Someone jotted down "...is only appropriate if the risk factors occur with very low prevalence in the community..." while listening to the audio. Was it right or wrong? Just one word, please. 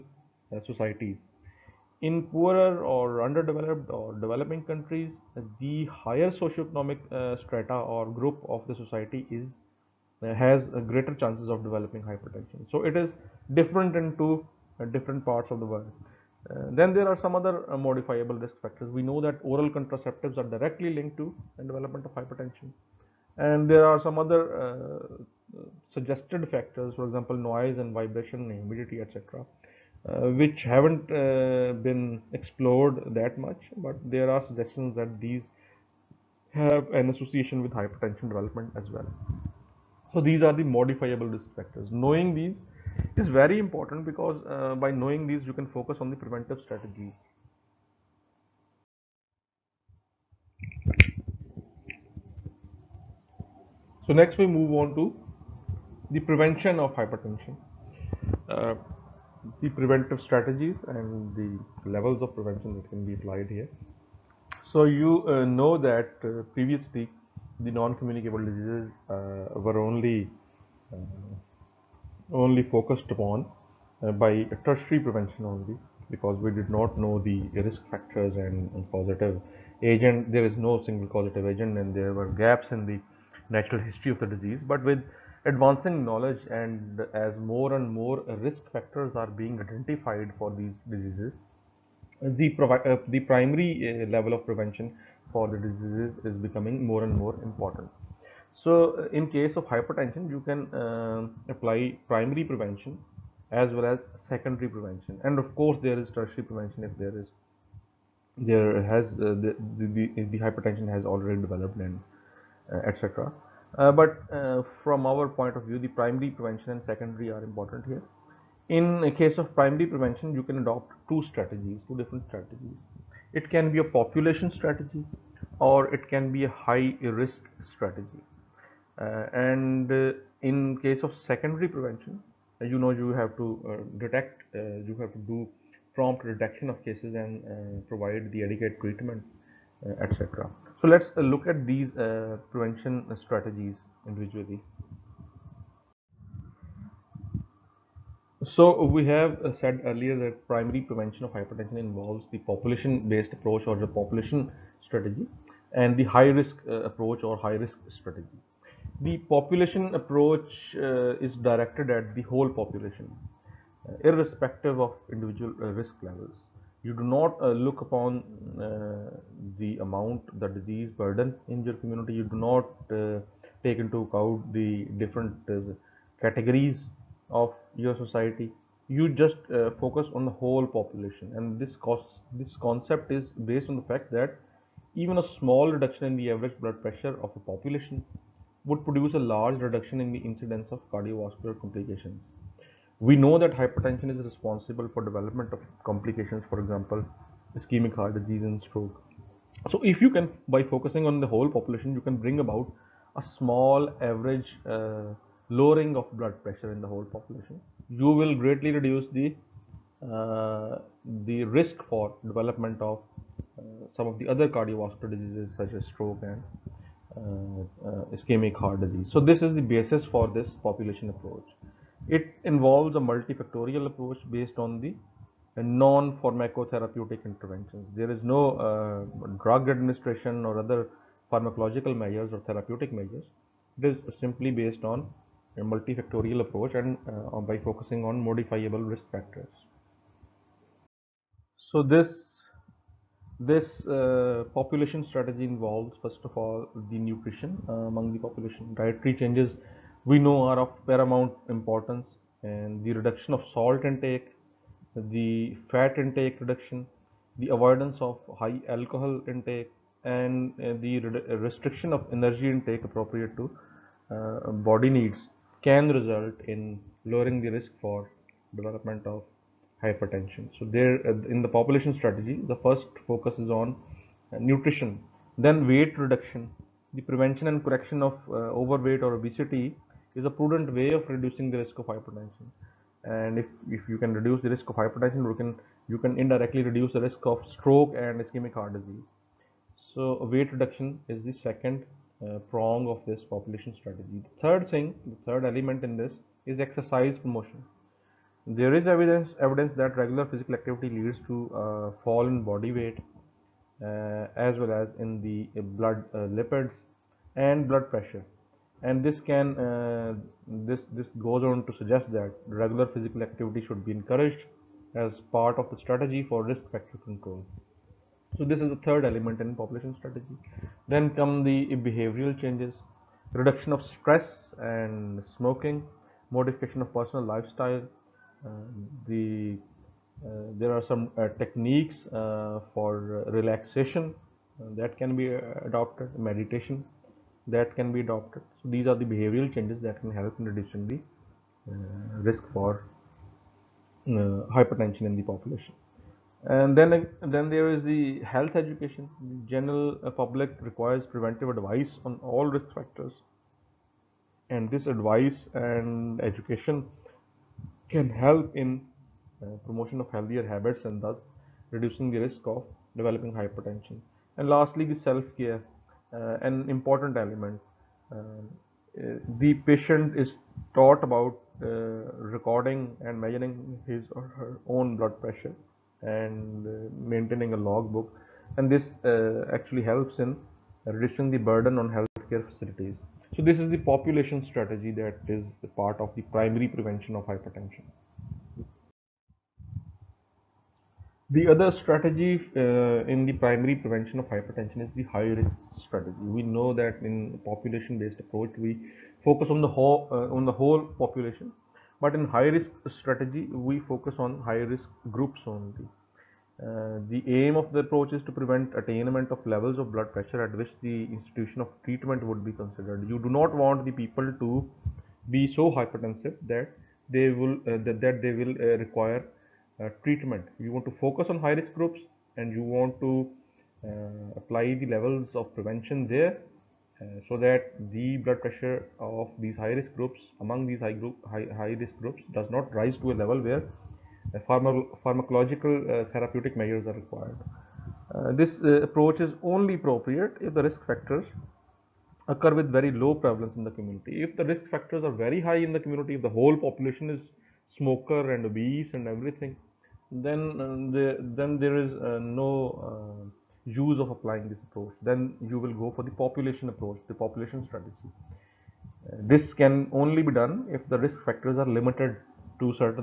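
right.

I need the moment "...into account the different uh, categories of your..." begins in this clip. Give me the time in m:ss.
2:53.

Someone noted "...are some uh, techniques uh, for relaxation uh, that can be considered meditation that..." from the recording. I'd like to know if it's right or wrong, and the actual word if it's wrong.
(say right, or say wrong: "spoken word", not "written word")
wrong: "adopted", not "considered".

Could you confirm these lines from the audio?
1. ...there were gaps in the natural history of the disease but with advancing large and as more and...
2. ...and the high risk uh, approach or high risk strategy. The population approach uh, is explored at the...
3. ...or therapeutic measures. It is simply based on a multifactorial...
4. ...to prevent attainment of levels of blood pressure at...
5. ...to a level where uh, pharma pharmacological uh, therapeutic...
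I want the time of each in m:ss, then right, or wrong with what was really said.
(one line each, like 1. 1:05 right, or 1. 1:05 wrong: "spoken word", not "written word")
1. 1:21 wrong: "knowledge", not "large"
2. 2:35 wrong: "directed", not "explored"
3. 3:52 right
4. 6:48 right
5. 7:13 right.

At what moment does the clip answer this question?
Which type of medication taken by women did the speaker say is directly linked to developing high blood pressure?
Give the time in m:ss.
0:19.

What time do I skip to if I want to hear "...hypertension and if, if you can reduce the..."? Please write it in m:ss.
4:41.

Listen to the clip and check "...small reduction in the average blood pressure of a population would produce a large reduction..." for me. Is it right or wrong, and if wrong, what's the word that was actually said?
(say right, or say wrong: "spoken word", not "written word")
right.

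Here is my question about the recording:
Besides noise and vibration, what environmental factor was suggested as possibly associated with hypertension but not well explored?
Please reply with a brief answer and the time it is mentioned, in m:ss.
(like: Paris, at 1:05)
Humidity, at 0:28.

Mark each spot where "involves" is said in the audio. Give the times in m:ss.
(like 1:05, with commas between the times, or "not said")
2:31, 3:42, 4:05.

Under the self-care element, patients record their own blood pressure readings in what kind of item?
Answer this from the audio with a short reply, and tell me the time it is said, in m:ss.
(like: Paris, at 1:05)
A logbook, at 6:17.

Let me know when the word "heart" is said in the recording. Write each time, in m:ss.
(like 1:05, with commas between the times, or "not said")
3:17, 3:38, 4:48.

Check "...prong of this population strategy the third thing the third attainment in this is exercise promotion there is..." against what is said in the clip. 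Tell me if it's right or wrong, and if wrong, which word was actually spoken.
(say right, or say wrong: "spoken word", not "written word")
wrong: "element", not "attainment".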